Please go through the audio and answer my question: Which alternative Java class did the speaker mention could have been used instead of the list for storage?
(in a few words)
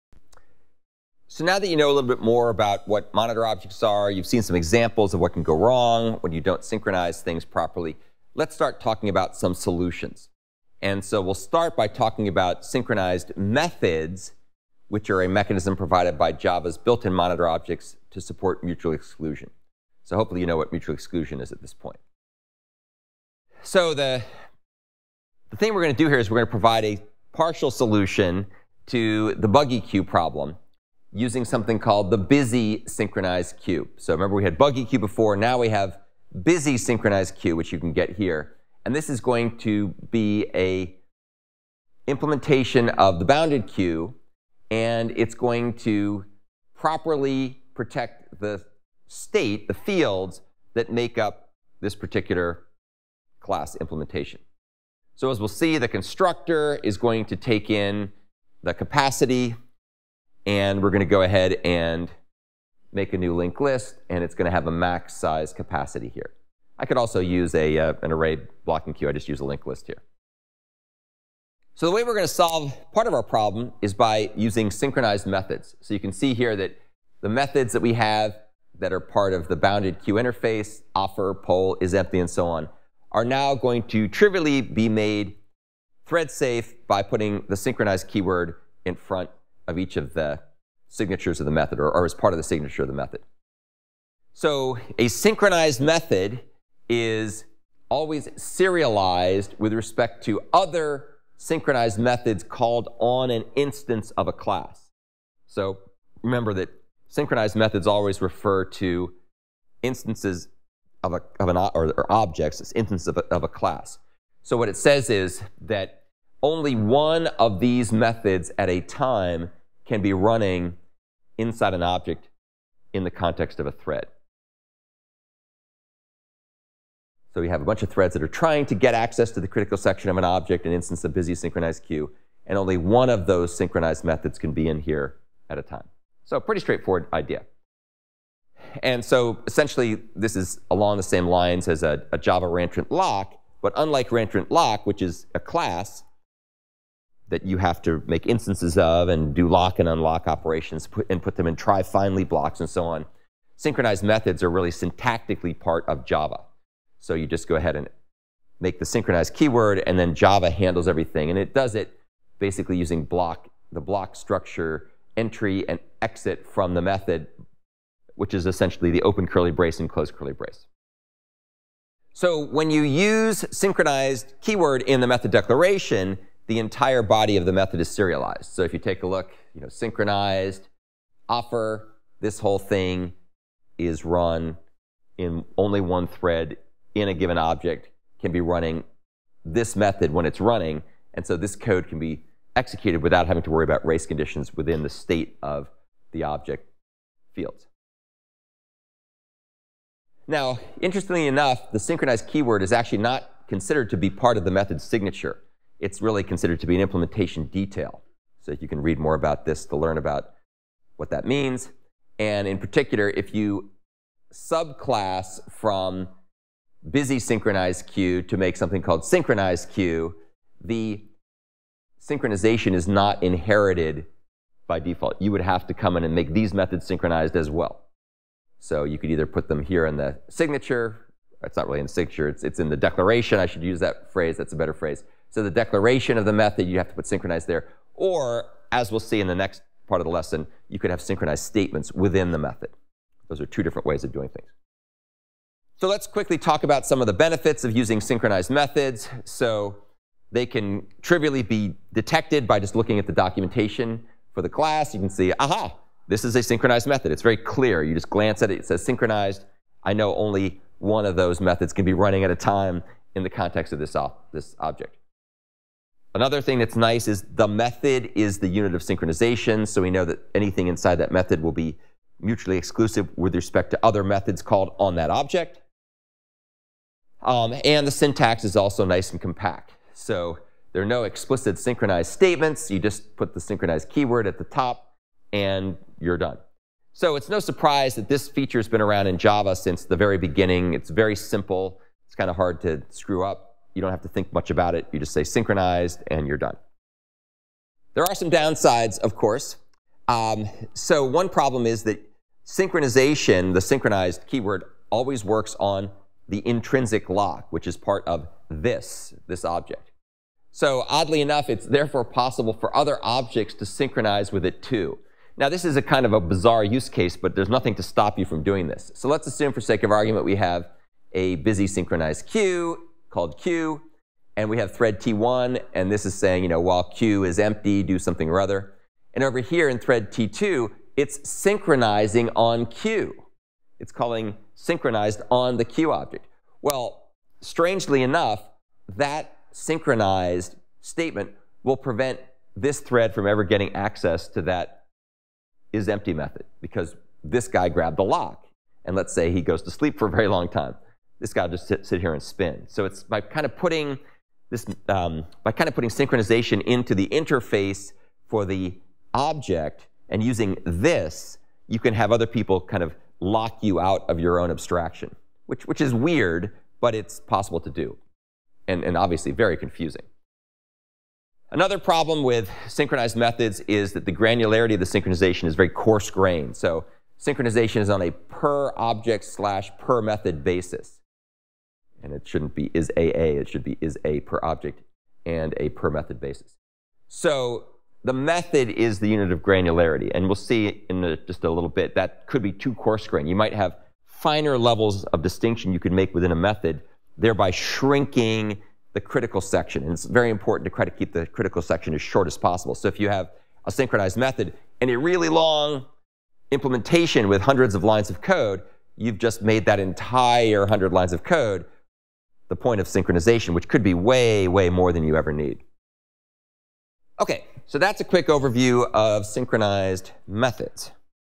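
array blocking queue.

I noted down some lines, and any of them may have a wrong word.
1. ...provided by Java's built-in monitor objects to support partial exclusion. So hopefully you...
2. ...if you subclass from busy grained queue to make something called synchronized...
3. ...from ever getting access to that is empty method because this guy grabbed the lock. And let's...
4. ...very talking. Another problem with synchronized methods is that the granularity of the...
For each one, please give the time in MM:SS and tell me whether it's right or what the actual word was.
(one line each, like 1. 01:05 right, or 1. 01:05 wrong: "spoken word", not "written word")
1. 00:15 wrong: "mutual", not "partial"
2. 03:33 wrong: "synchronized", not "grained"
3. 05:43 right
4. 06:09 wrong: "confusing", not "talking".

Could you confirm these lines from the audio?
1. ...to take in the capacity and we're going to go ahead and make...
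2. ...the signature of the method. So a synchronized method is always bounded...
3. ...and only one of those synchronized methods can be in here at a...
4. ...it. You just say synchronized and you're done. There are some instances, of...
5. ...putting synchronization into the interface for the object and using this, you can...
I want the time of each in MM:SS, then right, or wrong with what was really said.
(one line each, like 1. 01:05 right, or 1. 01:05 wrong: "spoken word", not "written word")
1. 00:57 right
2. 01:32 wrong: "serialized", not "bounded"
3. 02:12 right
4. 04:54 wrong: "downsides", not "instances"
5. 05:55 right.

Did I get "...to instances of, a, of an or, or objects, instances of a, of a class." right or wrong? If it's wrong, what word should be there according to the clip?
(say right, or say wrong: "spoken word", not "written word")
right.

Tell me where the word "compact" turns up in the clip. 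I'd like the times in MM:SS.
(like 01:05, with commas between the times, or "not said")
04:39.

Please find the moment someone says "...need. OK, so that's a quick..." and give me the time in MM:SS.
06:55.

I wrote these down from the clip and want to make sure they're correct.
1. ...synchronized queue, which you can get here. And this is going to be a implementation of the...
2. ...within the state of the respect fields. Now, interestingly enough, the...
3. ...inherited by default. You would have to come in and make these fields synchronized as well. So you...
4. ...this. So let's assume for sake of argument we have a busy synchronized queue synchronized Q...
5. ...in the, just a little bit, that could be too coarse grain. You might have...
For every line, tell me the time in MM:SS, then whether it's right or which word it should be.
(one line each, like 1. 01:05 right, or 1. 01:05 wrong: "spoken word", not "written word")
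1. 00:36 right
2. 03:14 wrong: "object", not "respect"
3. 03:43 wrong: "methods", not "fields"
4. 05:18 wrong: "called", not "synchronized"
5. 06:30 right.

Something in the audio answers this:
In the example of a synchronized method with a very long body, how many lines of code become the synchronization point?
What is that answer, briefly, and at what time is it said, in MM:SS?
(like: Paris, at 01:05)
100, at 06:50.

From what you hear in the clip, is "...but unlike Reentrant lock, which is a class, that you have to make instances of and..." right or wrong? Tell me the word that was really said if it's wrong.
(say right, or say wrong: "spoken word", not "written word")
right.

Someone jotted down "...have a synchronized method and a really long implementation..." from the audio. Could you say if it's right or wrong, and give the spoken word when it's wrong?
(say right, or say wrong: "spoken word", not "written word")
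right.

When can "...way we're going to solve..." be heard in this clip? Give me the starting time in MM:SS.
01:11.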